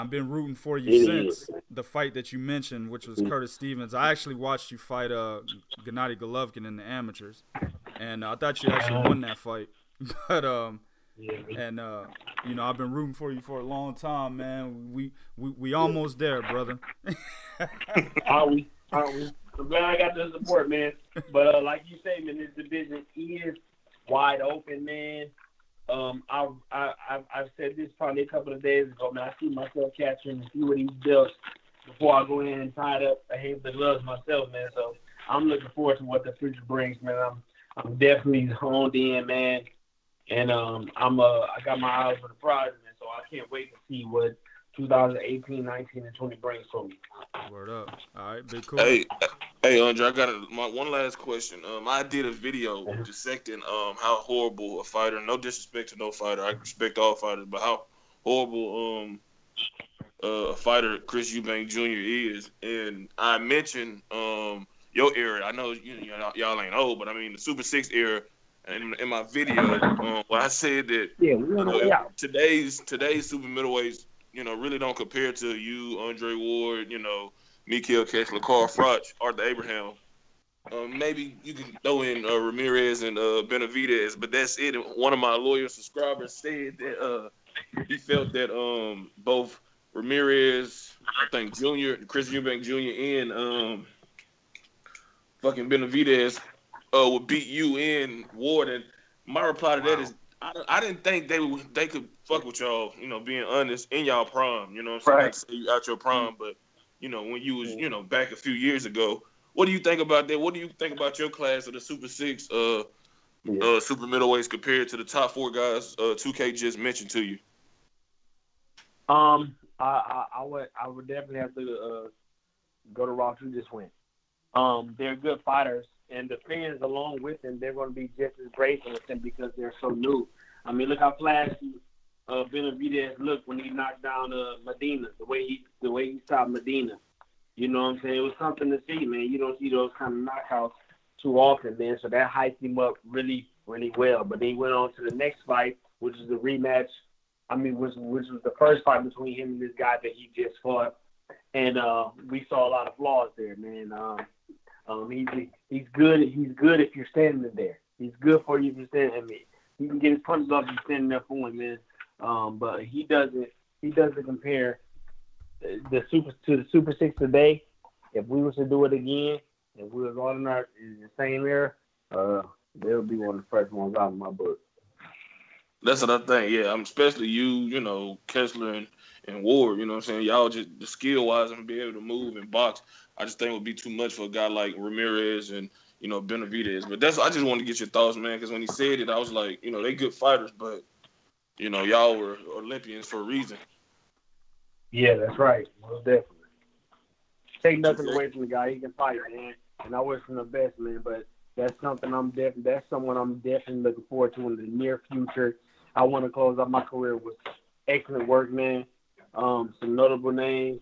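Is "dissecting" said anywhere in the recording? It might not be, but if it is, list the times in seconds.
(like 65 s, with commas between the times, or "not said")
53 s.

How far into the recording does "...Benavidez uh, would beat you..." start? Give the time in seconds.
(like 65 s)
95 s.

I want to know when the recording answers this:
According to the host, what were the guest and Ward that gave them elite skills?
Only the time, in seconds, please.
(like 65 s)
192 s.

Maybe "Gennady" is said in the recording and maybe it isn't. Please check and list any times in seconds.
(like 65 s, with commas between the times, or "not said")
5 s.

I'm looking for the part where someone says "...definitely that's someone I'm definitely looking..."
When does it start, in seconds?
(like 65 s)
202 s.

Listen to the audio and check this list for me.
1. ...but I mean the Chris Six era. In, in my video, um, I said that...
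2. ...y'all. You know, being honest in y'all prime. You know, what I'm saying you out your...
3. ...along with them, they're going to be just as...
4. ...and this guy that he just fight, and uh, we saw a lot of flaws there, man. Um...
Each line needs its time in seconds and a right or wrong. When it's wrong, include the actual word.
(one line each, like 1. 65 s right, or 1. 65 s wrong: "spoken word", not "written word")
1. 66 s wrong: "Super", not "Chris"
2. 102 s right
3. 126 s right
4. 149 s wrong: "fought", not "fight".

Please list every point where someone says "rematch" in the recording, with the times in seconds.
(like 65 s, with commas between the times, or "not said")
146 s.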